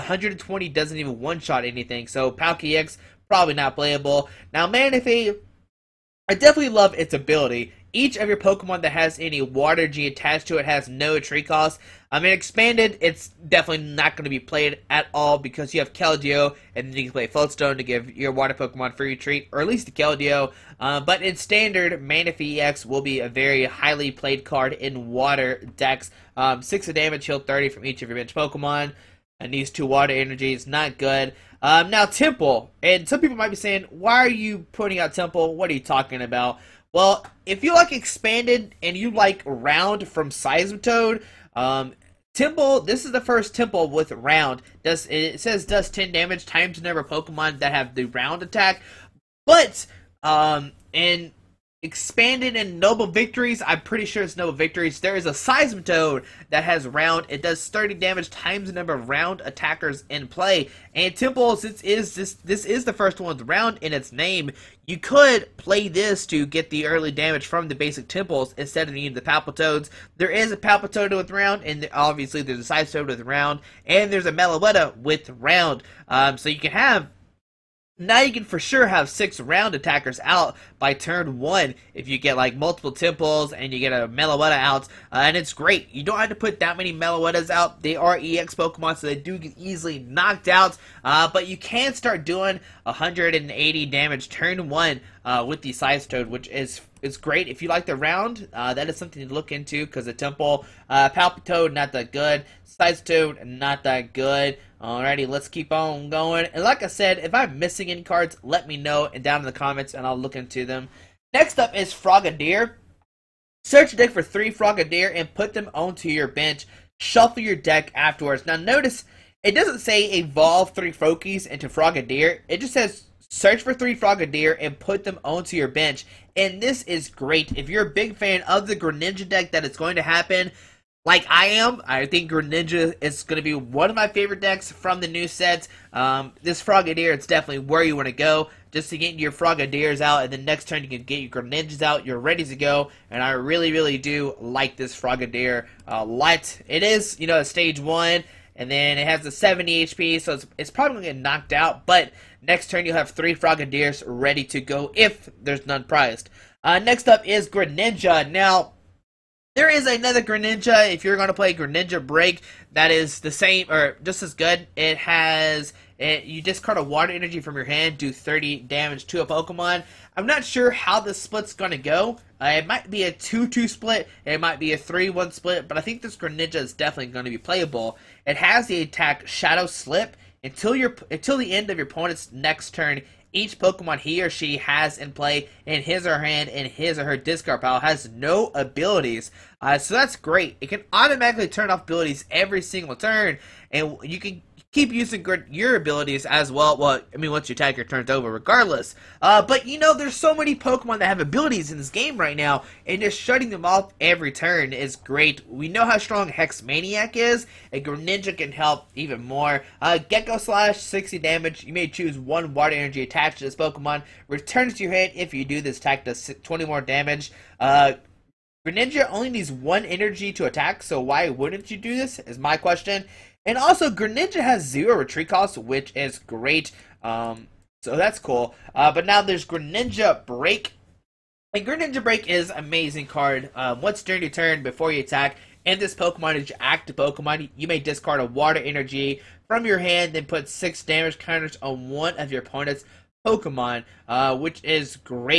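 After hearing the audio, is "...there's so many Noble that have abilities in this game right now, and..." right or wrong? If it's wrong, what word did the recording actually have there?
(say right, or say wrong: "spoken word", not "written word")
wrong: "Pokemon", not "Noble".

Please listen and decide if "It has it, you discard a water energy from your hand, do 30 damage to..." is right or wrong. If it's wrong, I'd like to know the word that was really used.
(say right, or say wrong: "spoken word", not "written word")
right.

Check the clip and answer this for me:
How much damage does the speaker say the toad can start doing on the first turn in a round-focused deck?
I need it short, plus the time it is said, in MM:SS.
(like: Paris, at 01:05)
180, at 01:32.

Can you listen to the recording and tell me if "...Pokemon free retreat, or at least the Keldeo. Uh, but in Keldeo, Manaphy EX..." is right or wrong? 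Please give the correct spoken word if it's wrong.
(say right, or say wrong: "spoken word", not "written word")
wrong: "Standard", not "Keldeo".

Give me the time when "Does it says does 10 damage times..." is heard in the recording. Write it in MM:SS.
00:44.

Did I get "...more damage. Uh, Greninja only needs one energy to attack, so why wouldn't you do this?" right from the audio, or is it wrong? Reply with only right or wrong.
right.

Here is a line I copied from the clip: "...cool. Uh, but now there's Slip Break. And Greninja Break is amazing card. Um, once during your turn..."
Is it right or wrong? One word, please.
wrong.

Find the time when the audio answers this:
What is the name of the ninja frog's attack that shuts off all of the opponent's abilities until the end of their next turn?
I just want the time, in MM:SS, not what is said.
02:59.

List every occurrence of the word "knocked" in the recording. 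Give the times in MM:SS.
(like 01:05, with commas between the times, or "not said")
01:29, 02:31.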